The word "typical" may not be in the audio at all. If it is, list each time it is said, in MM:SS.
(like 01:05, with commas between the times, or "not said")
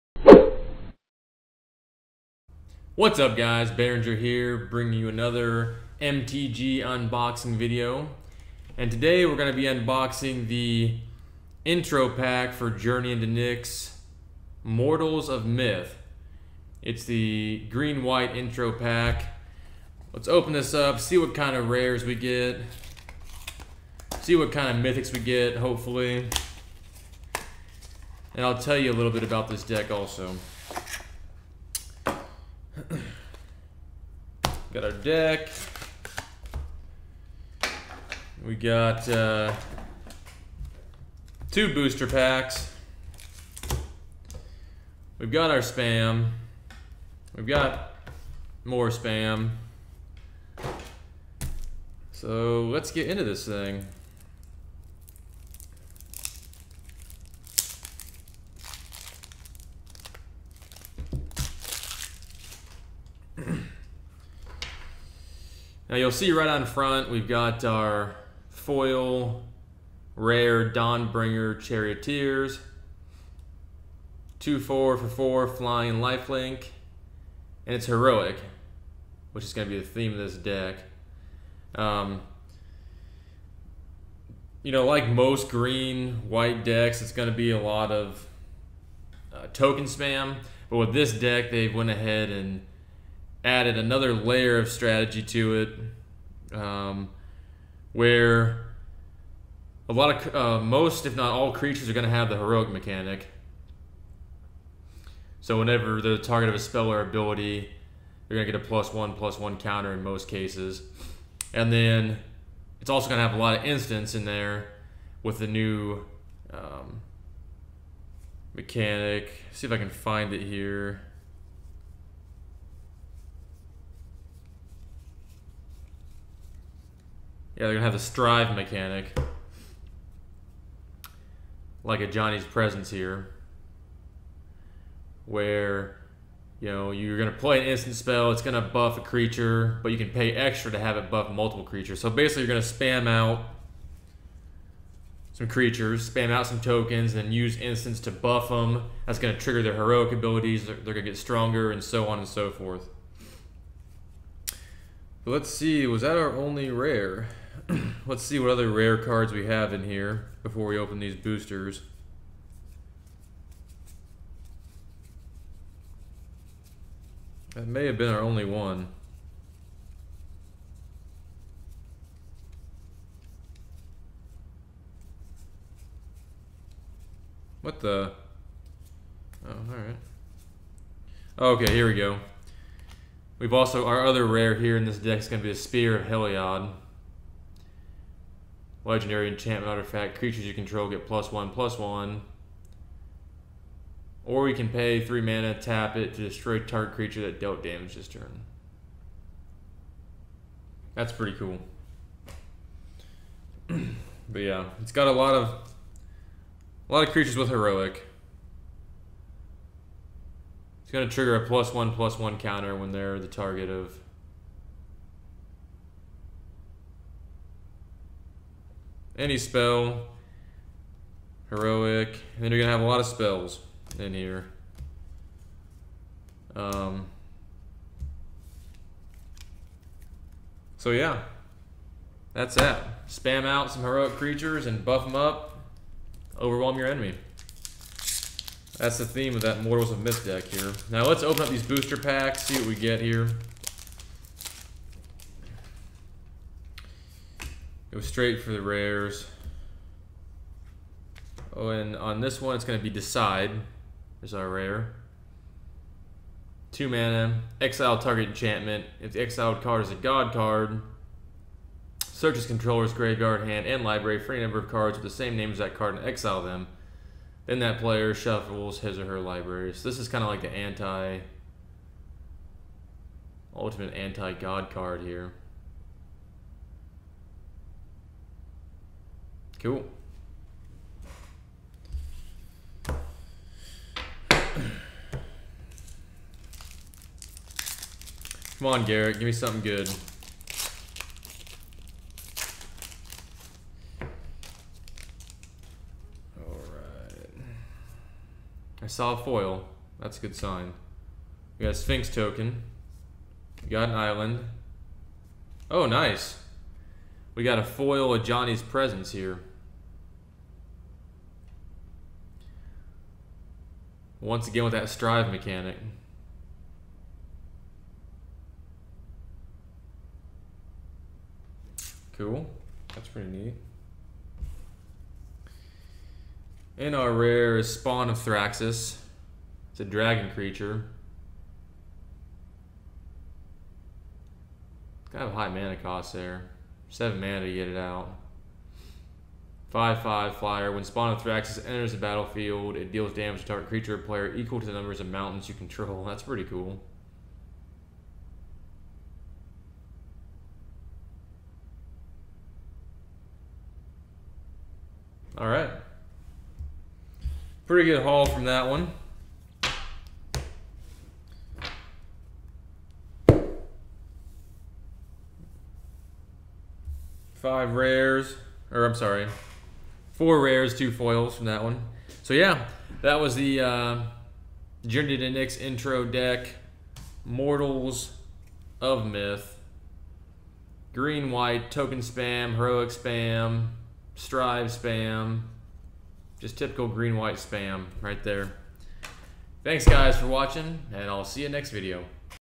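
06:26.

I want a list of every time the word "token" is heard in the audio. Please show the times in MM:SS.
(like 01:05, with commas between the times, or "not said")
01:29, 02:26, 05:02, 06:21.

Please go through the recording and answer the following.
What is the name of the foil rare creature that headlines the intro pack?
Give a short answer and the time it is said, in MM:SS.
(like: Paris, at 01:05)
Dawnbringer Charioteers, at 01:10.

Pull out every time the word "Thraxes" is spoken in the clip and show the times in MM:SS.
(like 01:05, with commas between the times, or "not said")
05:28, 05:40.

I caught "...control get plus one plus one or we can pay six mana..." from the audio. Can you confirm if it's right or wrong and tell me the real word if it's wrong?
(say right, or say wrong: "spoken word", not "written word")
wrong: "three", not "six".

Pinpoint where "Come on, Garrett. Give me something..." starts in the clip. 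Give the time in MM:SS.
04:48.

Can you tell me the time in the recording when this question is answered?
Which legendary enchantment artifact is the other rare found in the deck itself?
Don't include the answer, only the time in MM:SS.
03:05.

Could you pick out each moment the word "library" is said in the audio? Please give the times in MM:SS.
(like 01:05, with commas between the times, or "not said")
04:23, 04:29.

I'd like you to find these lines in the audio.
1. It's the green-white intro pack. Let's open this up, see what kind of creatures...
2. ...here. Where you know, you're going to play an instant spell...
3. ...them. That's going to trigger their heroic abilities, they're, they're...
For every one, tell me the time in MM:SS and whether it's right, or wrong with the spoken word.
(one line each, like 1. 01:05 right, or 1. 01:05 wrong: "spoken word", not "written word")
1. 00:16 wrong: "rares", not "creatures"
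2. 02:12 right
3. 02:28 right.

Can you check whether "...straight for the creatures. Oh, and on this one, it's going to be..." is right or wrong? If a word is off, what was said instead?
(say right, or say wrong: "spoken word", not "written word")
wrong: "rares", not "creatures".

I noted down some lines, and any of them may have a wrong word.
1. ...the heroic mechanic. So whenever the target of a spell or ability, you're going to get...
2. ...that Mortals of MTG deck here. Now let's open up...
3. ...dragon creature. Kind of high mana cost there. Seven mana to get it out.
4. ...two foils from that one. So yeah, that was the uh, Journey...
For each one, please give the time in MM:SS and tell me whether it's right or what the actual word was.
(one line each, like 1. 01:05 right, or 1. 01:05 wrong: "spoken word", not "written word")
1. 01:42 right
2. 03:59 wrong: "Myth", not "MTG"
3. 05:29 right
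4. 06:10 right.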